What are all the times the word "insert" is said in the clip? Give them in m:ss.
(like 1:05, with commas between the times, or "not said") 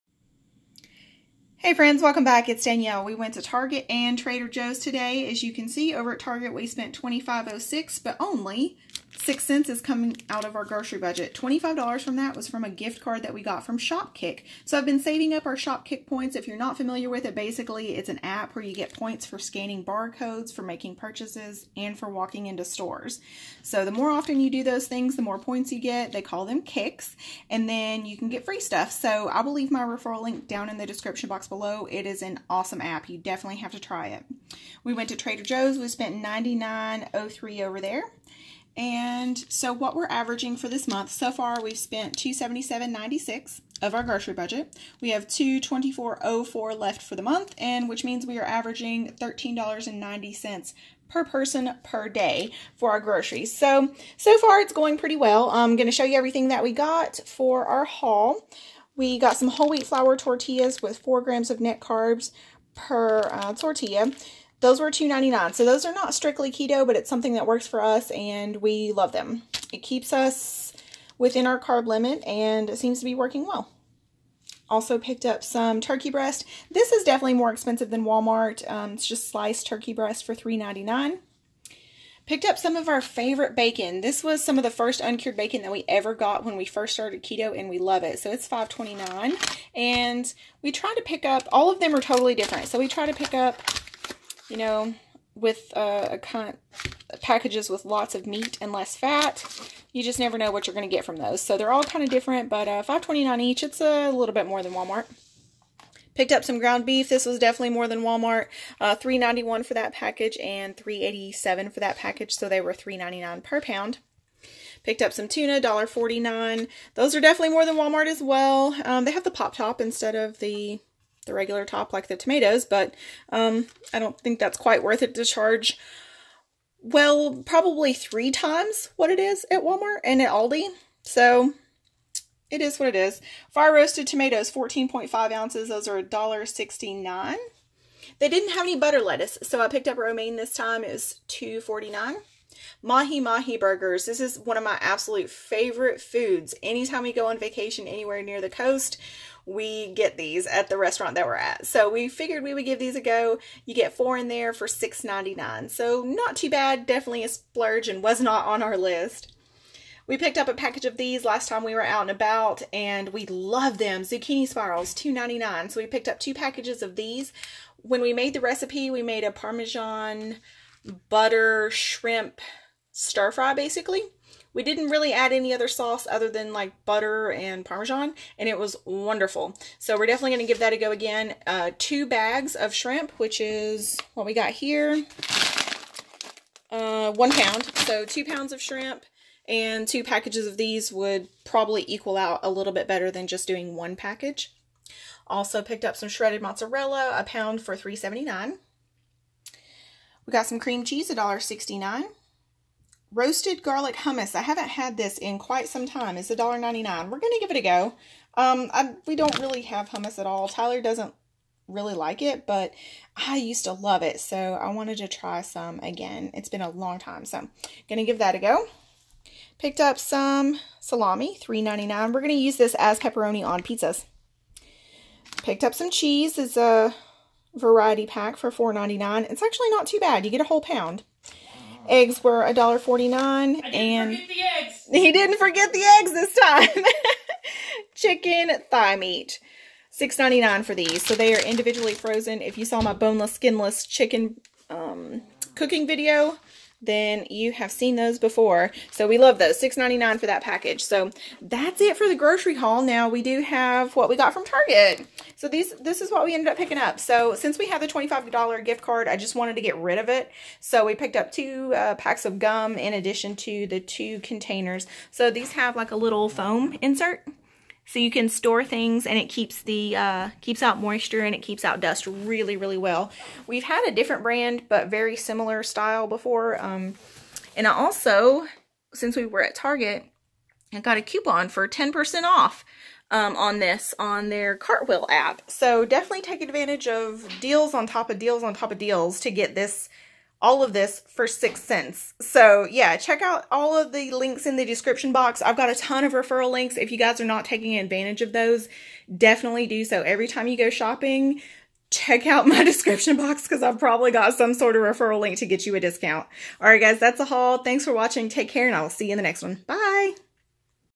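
4:26.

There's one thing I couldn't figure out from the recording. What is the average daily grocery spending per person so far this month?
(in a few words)
$13.90.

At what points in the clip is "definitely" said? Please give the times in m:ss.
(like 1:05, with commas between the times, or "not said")
0:33, 1:17, 1:47, 1:57, 2:36, 3:00, 4:45, 4:59.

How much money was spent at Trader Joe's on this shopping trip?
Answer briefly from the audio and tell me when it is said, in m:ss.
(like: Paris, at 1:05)
$99.03, at 0:36.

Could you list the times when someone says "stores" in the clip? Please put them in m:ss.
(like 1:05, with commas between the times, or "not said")
0:22, 4:28.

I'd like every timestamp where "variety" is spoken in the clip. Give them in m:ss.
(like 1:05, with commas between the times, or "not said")
3:47.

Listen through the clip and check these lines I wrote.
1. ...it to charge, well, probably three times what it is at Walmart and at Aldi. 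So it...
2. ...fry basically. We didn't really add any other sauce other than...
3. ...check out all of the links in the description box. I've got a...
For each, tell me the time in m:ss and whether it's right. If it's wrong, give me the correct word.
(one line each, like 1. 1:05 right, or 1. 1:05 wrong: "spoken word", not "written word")
1. 2:05 right
2. 2:53 right
3. 4:52 right.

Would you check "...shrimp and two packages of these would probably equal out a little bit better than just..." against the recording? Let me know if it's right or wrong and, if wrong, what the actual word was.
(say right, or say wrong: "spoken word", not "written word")
right.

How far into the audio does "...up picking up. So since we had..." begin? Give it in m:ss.
4:16.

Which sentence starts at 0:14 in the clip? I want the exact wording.
So I've been saving up our Shopkick points.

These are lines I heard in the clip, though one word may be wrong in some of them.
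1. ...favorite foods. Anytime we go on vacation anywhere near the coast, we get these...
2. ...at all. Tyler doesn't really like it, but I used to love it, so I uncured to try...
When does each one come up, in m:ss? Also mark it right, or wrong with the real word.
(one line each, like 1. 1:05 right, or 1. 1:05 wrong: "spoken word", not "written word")
1. 2:25 right
2. 3:30 wrong: "wanted", not "uncured".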